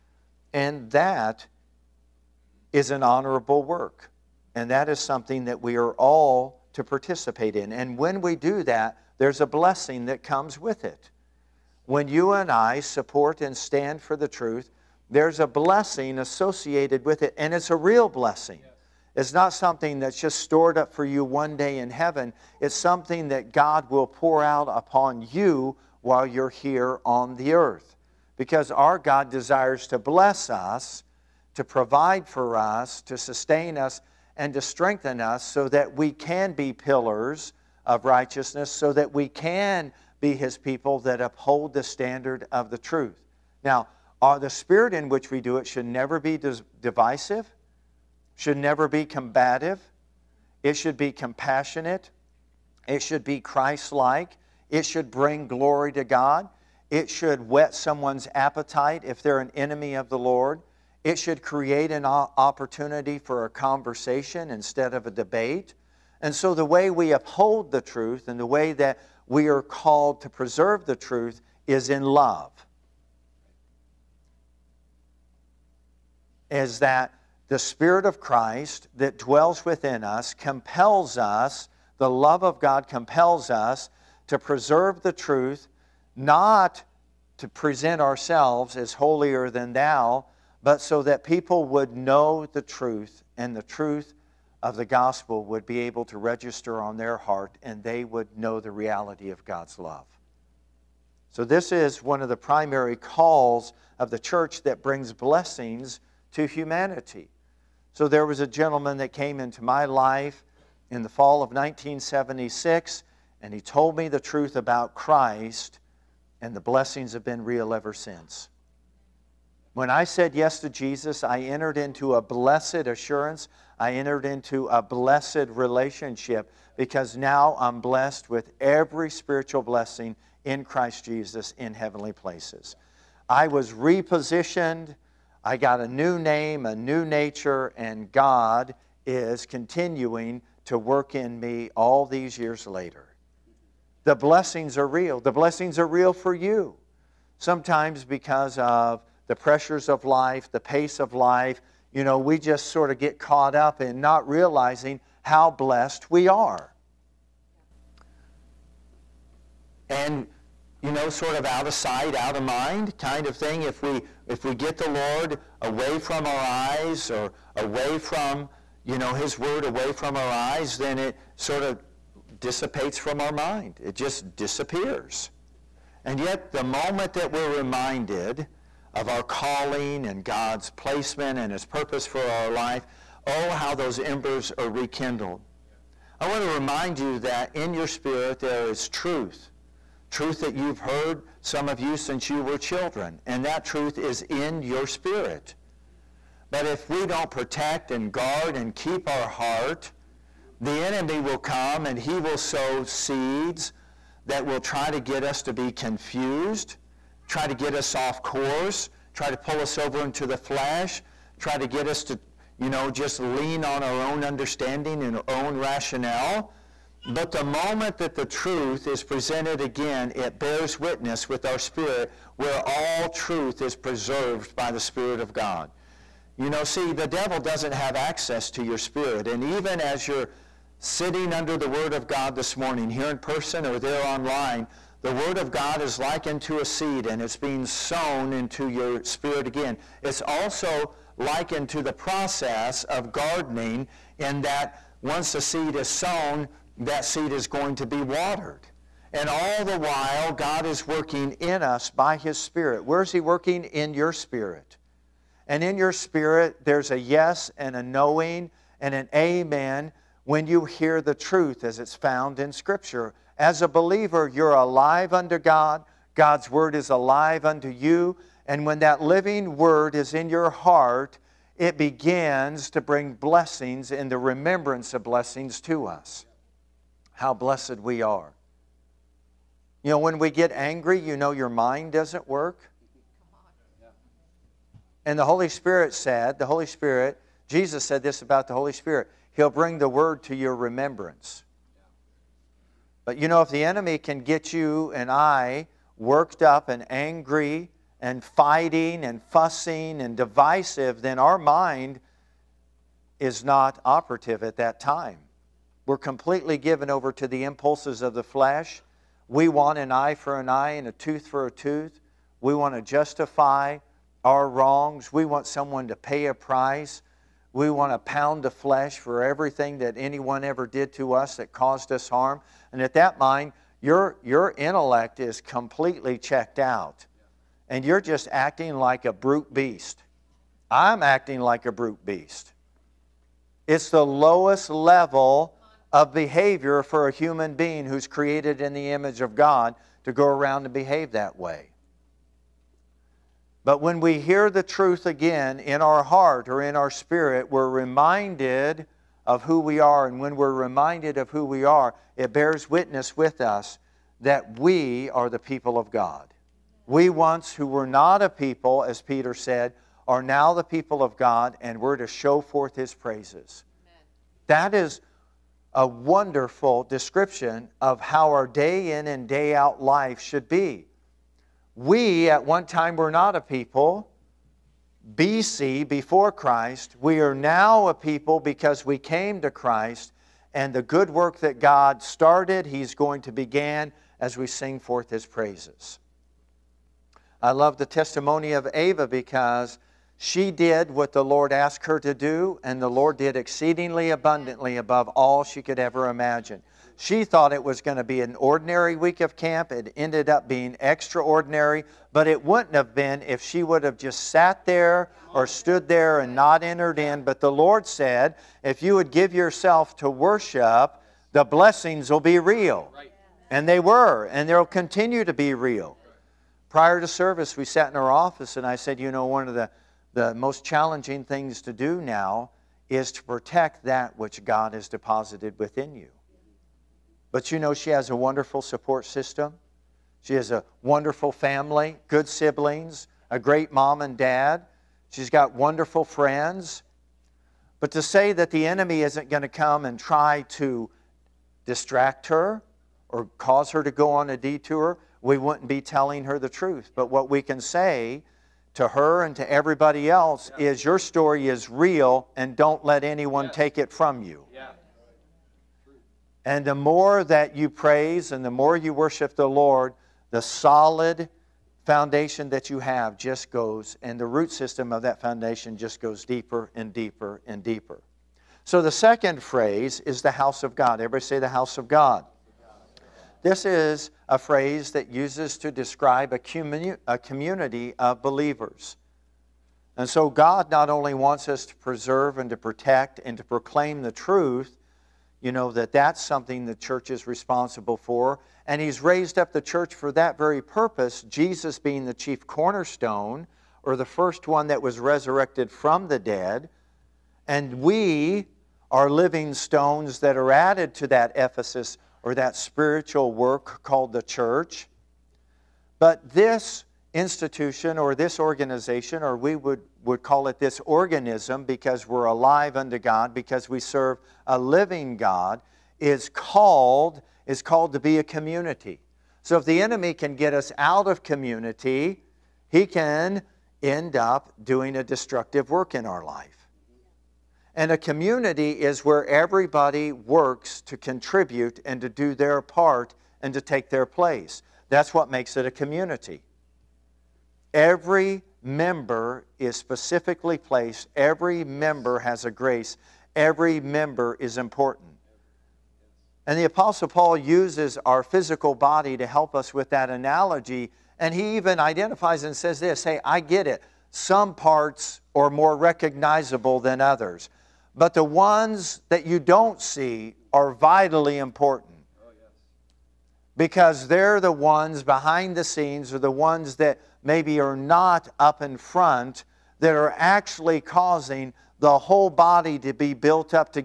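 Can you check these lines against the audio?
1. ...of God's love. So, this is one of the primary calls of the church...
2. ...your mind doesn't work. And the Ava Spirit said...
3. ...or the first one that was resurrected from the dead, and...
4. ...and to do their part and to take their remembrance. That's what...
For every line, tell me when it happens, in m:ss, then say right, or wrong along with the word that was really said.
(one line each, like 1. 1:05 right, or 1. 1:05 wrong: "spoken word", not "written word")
1. 1:39 right
2. 4:41 wrong: "Holy", not "Ava"
3. 8:13 right
4. 8:51 wrong: "place", not "remembrance".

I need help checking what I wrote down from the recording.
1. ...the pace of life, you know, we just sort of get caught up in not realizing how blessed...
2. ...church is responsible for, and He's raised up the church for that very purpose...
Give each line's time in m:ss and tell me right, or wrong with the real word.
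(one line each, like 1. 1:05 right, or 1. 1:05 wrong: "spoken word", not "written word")
1. 2:30 right
2. 8:06 right.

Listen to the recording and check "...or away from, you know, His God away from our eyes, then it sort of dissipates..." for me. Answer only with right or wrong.
wrong.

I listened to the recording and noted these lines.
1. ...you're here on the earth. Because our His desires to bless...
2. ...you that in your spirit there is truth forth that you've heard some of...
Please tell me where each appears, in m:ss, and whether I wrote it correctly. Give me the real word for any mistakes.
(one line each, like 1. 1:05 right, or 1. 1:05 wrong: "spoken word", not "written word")
1. 0:26 wrong: "God", not "His"
2. 3:07 wrong: "truth", not "forth".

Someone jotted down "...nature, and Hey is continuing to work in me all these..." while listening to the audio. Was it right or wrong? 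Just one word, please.
wrong.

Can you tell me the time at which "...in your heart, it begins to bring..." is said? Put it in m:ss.
4:30.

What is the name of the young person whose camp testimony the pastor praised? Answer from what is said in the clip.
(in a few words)
Ava.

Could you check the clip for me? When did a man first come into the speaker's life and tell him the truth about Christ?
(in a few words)
fall of 1976.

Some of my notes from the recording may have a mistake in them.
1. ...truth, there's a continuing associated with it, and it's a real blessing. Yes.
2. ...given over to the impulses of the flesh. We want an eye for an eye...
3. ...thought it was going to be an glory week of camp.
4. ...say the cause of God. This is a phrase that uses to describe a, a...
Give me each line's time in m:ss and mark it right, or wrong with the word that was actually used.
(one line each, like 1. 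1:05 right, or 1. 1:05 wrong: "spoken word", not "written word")
1. 0:14 wrong: "blessing", not "continuing"
2. 5:06 right
3. 6:37 wrong: "ordinary", not "glory"
4. 7:51 wrong: "house", not "cause".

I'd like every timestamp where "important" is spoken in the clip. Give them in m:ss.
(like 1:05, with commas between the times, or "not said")
9:04, 9:21.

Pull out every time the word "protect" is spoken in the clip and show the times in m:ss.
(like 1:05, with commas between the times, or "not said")
3:17, 7:03, 8:02.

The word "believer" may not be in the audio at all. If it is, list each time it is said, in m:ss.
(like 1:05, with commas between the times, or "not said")
4:23, 7:58.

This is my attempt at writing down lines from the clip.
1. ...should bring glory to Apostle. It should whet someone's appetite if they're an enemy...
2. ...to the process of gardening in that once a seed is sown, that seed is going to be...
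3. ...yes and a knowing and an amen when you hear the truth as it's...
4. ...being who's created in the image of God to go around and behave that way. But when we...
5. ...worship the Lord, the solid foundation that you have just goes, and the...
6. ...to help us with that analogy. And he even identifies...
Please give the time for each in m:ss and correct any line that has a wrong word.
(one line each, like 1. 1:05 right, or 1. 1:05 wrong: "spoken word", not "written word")
1. 0:54 wrong: "God", not "Apostle"
2. 4:01 right
3. 4:16 right
4. 5:37 right
5. 7:38 right
6. 9:09 right.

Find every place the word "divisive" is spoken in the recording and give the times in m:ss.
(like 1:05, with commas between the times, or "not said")
0:46, 5:00.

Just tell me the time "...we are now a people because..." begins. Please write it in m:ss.
6:17.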